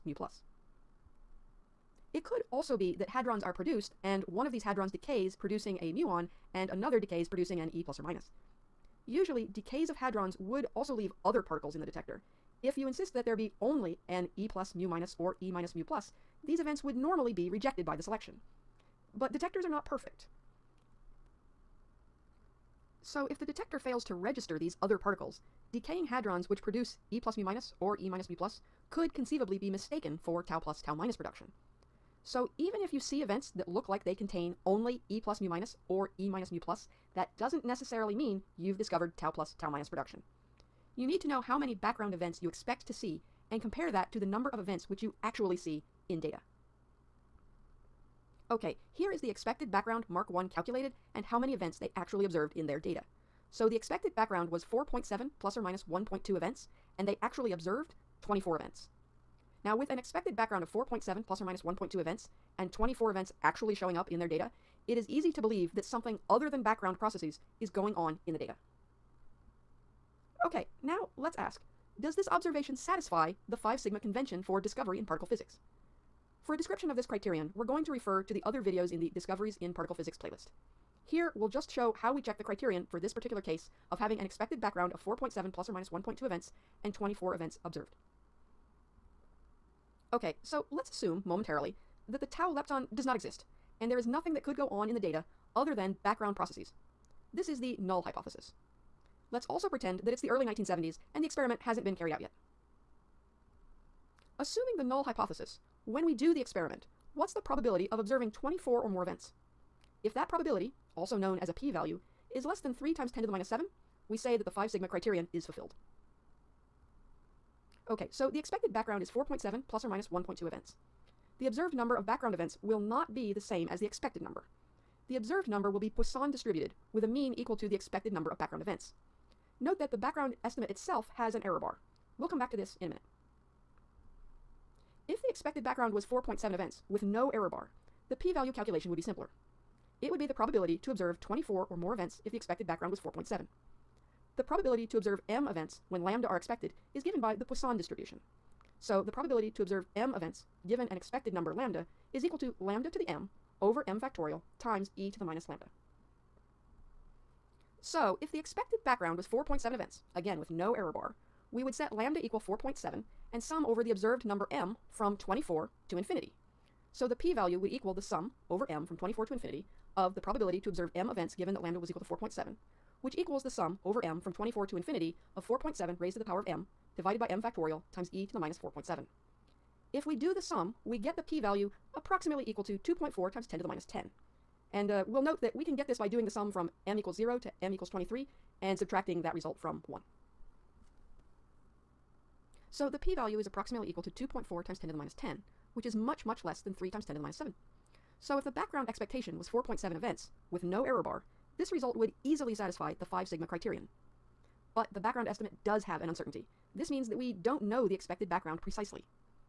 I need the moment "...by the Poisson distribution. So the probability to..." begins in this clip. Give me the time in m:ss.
2:27.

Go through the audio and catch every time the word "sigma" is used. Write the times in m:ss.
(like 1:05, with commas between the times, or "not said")
1:13, 1:54, 3:23.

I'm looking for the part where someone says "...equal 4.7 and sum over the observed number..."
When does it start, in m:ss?
2:42.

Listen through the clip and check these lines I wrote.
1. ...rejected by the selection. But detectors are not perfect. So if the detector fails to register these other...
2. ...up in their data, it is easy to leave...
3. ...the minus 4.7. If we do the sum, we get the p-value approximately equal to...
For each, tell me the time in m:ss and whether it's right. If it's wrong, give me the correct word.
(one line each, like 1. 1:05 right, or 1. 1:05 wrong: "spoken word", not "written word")
1. 0:17 right
2. 1:03 wrong: "believe", not "leave"
3. 2:58 right.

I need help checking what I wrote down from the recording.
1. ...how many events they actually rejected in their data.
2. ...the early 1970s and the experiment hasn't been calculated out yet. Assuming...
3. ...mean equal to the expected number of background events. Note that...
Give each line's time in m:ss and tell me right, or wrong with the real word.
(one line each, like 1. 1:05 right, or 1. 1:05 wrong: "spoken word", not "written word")
1. 0:51 wrong: "observed", not "rejected"
2. 1:40 wrong: "carried", not "calculated"
3. 2:07 right.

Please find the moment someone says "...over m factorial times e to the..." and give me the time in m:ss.
2:33.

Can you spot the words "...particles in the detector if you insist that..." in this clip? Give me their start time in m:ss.
0:11.